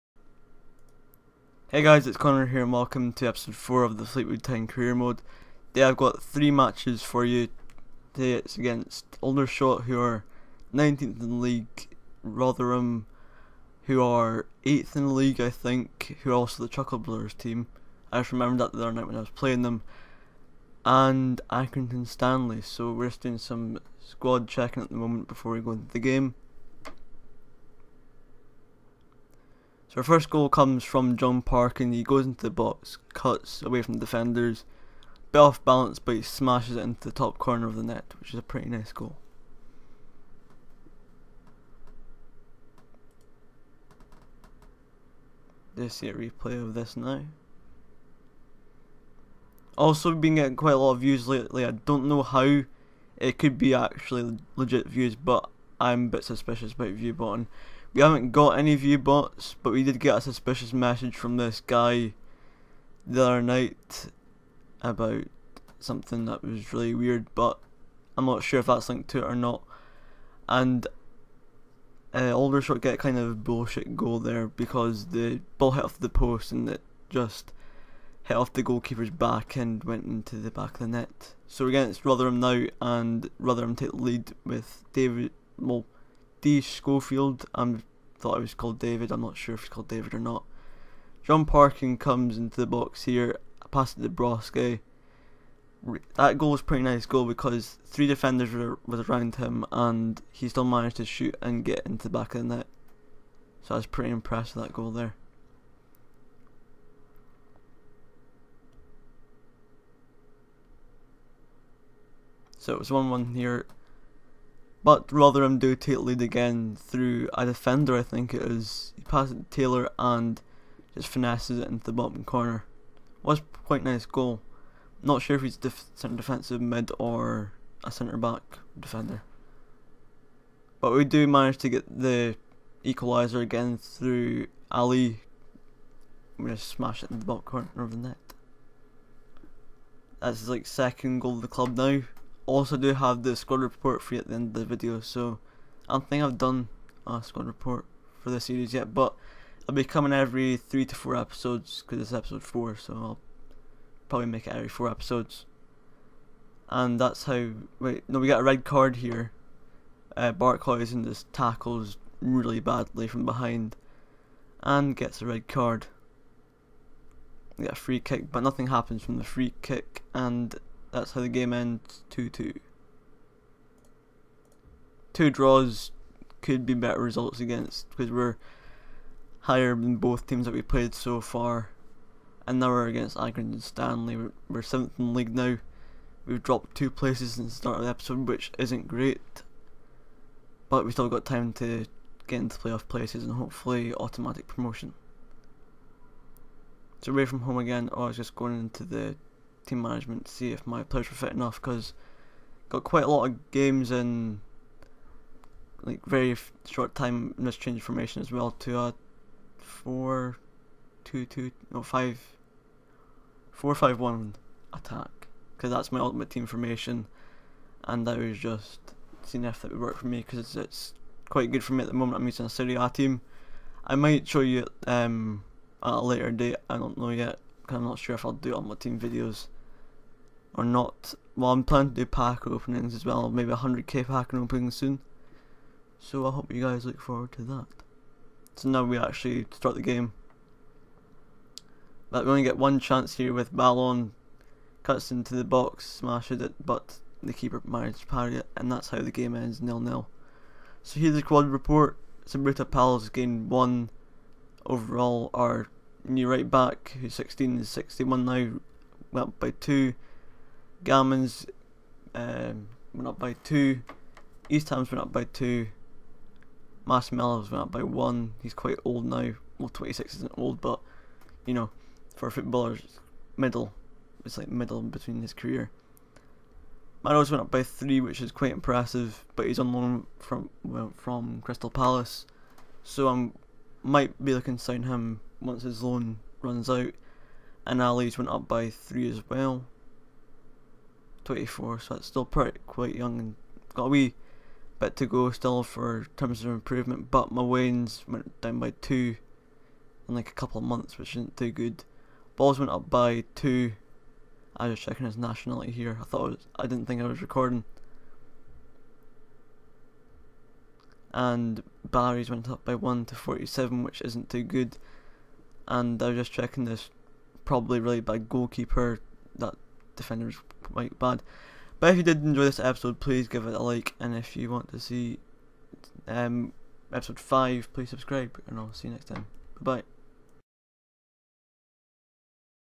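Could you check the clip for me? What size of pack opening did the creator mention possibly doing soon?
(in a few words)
100k.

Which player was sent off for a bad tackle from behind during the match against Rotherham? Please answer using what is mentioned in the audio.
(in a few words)
Barkhuizen.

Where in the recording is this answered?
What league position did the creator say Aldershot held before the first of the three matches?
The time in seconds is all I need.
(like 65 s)
10 s.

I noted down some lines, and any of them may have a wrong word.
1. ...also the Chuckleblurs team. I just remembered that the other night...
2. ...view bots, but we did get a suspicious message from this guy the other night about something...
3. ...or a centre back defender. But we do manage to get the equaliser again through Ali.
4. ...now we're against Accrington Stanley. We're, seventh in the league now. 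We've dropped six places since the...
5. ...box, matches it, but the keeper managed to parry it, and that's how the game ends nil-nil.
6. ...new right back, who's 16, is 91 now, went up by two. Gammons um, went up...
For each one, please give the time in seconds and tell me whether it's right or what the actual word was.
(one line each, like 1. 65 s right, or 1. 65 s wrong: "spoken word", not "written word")
1. 16 s right
2. 58 s right
3. 126 s right
4. 182 s wrong: "two", not "six"
5. 245 s wrong: "smashes", not "matches"
6. 256 s wrong: "61", not "91".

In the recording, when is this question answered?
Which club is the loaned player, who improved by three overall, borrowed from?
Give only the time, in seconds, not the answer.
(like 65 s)
281 s.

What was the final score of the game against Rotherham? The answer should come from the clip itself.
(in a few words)
2-2.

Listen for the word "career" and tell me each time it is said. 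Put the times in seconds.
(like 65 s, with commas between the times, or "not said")
4 s, 275 s.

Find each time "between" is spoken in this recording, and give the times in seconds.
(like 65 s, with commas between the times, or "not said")
274 s.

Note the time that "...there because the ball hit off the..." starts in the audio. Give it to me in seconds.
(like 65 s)
74 s.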